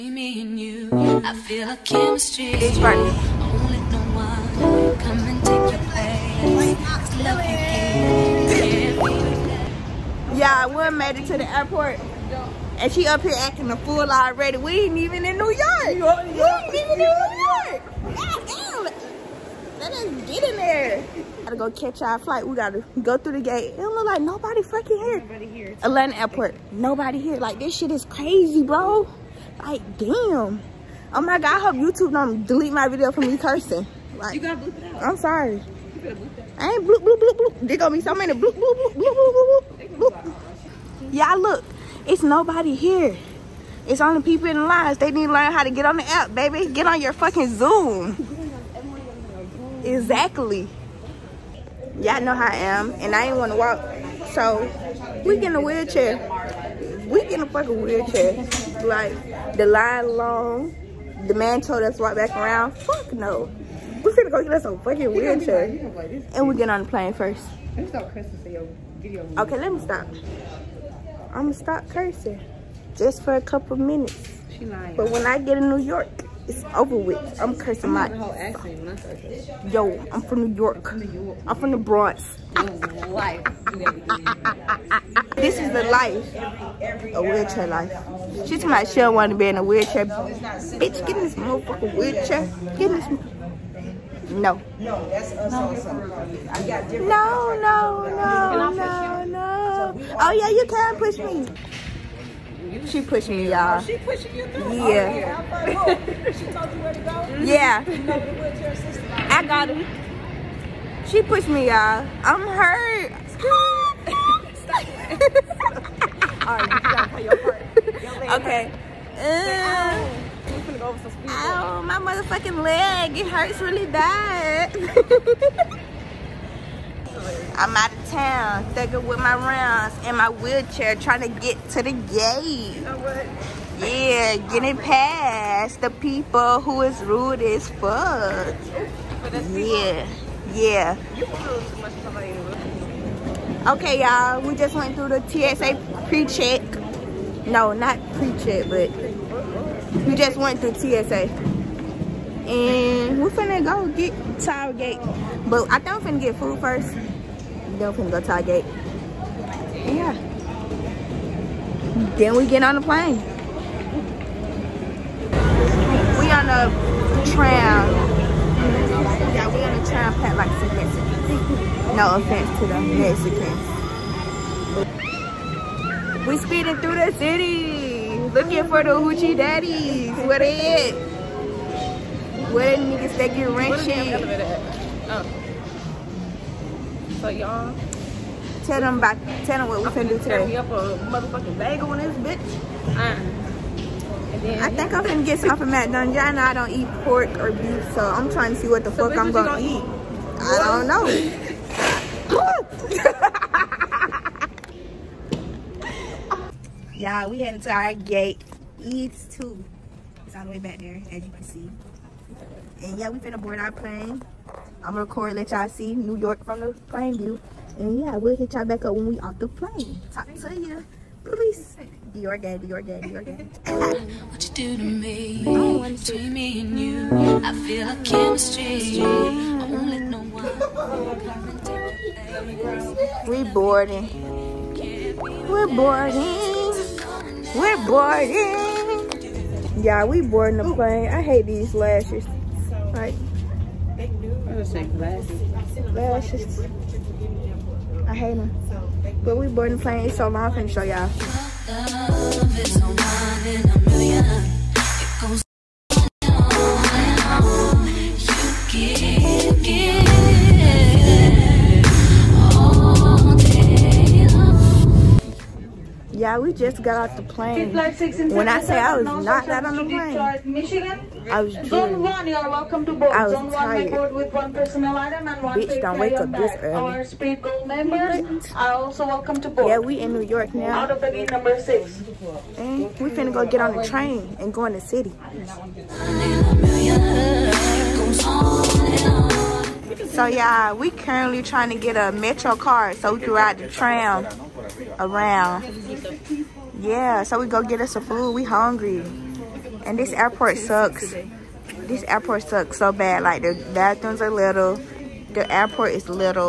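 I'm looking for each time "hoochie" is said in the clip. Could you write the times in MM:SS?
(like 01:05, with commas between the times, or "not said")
02:58.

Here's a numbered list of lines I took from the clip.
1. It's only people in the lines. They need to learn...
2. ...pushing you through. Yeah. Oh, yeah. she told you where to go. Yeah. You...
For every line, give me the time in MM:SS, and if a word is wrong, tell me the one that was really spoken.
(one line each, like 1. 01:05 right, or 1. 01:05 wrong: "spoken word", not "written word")
1. 00:43 right
2. 01:43 right.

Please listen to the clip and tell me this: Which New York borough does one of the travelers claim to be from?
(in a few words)
the Bronx.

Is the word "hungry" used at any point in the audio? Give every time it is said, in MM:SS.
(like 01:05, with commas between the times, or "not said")
04:58.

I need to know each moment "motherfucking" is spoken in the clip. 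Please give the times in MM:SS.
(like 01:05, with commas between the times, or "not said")
01:31, 02:01, 03:11.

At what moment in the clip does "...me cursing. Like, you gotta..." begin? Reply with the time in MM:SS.
00:33.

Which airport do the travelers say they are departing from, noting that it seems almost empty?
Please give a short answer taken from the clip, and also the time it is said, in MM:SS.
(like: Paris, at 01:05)
Atlanta Airport, at 00:25.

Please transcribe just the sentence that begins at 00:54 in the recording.
So, we get in a wheelchair we get in a fucking wheelchair.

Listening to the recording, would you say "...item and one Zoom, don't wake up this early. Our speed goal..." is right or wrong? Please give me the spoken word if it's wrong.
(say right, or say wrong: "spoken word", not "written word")
wrong: "Bitch", not "Zoom".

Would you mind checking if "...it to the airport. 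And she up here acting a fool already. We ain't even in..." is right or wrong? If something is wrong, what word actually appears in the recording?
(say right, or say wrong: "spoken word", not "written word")
right.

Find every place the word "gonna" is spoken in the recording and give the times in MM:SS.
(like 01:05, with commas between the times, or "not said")
00:37, 01:04, 01:11, 03:15, 03:19, 03:34.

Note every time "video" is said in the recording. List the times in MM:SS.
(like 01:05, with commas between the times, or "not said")
00:32, 01:08.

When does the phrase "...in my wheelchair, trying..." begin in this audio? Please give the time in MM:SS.
02:10.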